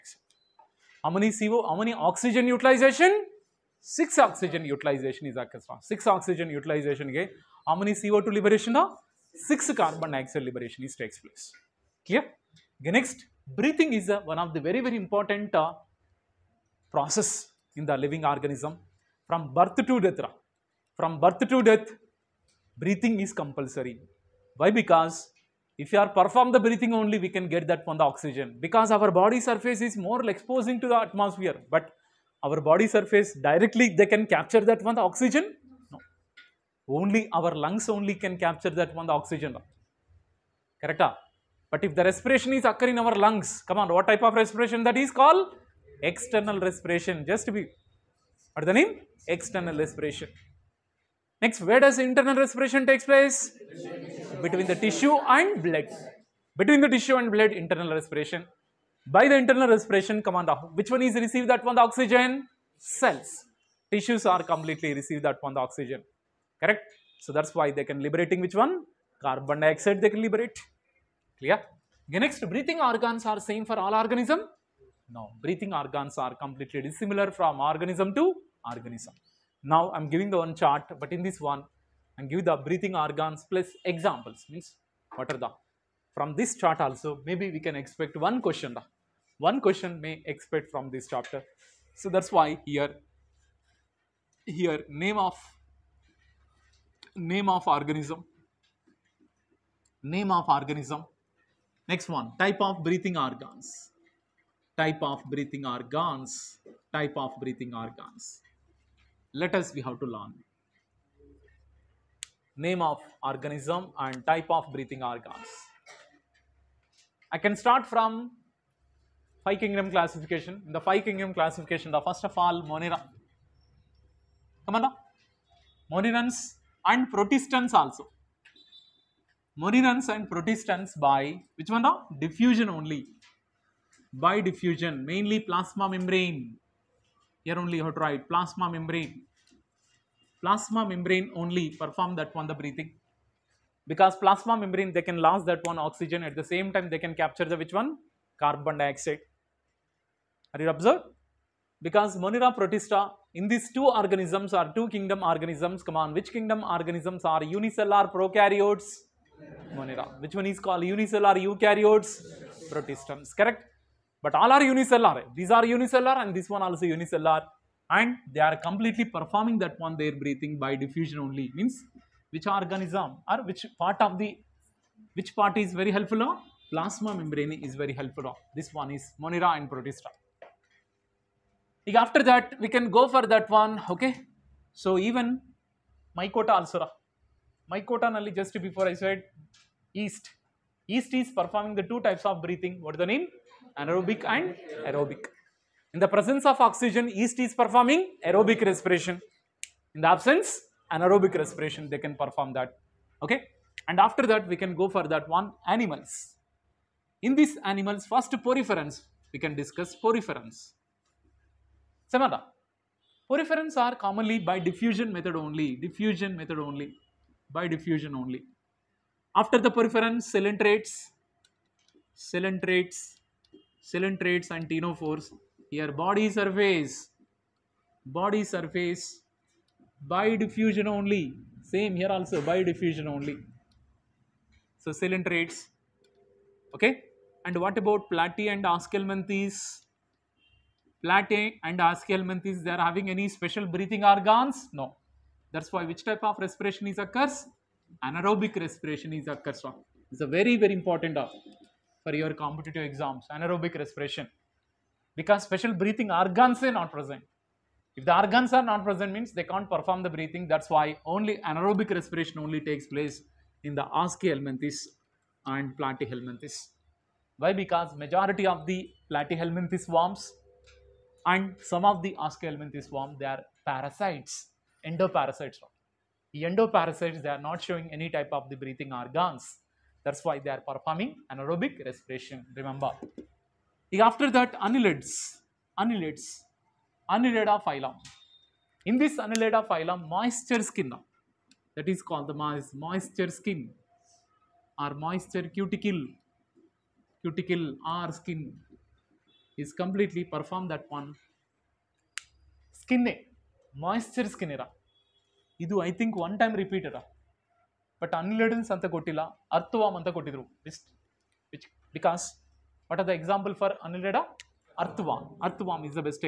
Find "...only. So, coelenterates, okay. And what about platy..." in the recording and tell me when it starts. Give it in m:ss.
3:53.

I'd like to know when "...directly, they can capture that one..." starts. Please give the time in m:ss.
0:33.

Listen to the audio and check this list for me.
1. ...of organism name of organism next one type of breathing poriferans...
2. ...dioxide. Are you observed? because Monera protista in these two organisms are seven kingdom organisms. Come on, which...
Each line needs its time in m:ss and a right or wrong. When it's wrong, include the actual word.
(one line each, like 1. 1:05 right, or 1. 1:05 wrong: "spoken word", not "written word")
1. 1:37 wrong: "organs", not "poriferans"
2. 2:28 wrong: "two", not "seven".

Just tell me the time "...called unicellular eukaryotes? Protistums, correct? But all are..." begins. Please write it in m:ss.
2:40.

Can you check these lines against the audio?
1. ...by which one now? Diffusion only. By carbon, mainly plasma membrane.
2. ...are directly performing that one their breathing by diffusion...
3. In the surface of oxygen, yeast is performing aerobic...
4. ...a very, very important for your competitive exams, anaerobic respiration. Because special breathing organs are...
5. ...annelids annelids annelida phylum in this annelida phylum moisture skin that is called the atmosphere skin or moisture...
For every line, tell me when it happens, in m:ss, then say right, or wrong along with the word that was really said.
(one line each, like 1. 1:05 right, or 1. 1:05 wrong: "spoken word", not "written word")
1. 2:10 wrong: "diffusion", not "carbon"
2. 2:48 wrong: "completely", not "directly"
3. 3:15 wrong: "presence", not "surface"
4. 4:10 right
5. 4:44 wrong: "moisture", not "atmosphere".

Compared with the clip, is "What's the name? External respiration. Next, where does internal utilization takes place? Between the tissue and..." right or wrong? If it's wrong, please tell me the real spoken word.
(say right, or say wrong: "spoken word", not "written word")
wrong: "respiration", not "utilization".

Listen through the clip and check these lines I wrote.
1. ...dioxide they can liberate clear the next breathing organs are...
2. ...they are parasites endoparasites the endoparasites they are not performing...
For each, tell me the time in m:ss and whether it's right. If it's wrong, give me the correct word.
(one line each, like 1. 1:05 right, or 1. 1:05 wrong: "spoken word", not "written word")
1. 1:09 right
2. 4:33 wrong: "showing", not "performing".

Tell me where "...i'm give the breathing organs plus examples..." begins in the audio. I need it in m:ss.
1:22.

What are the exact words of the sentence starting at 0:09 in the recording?
6 carbon dioxide liberation is takes place.